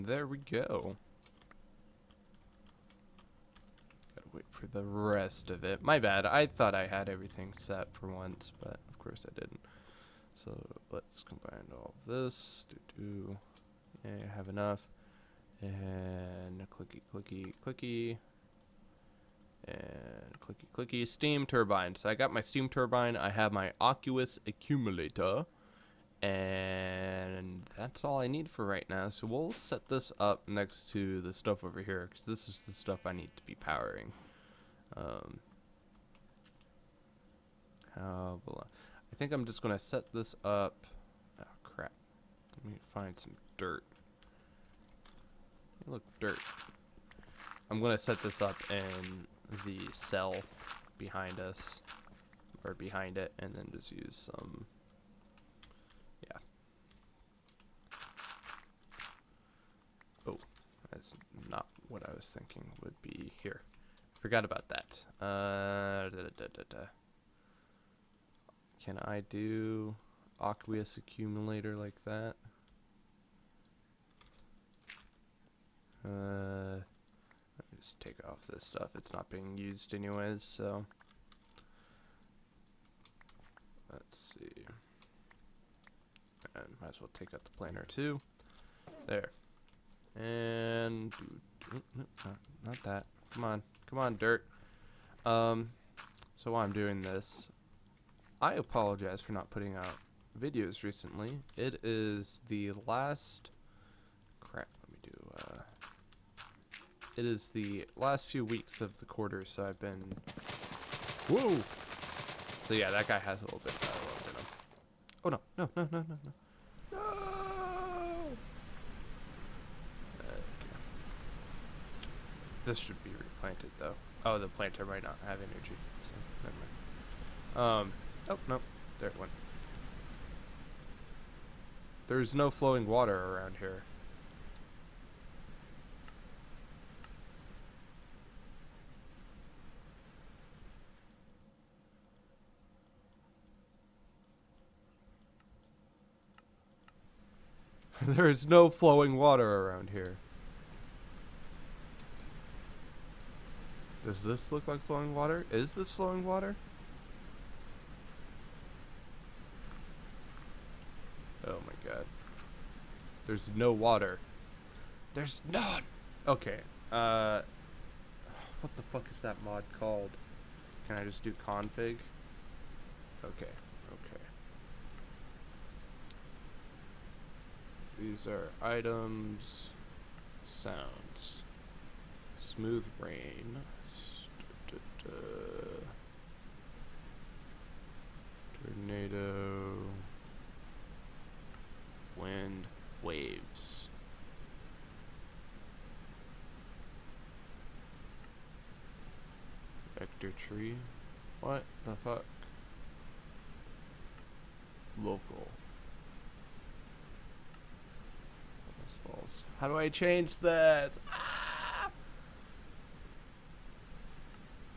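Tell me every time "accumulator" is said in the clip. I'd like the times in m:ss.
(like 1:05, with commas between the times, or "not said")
0:24, 1:10.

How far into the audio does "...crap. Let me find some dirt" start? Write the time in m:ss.
0:41.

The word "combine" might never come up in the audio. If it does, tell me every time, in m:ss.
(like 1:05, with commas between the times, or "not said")
0:11.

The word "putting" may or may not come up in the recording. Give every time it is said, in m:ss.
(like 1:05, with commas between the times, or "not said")
1:39.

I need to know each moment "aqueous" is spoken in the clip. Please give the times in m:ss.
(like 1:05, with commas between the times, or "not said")
0:23, 1:10.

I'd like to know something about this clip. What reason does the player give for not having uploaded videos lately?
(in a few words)
last few weeks of the quarter.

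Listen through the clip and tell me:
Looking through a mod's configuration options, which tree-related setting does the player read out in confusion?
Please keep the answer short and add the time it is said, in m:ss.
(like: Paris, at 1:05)
Vector tree, at 3:19.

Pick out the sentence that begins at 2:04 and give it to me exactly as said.
Oh, the planter might not have energy, so never mind.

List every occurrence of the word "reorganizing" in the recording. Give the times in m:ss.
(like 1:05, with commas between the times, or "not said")
not said.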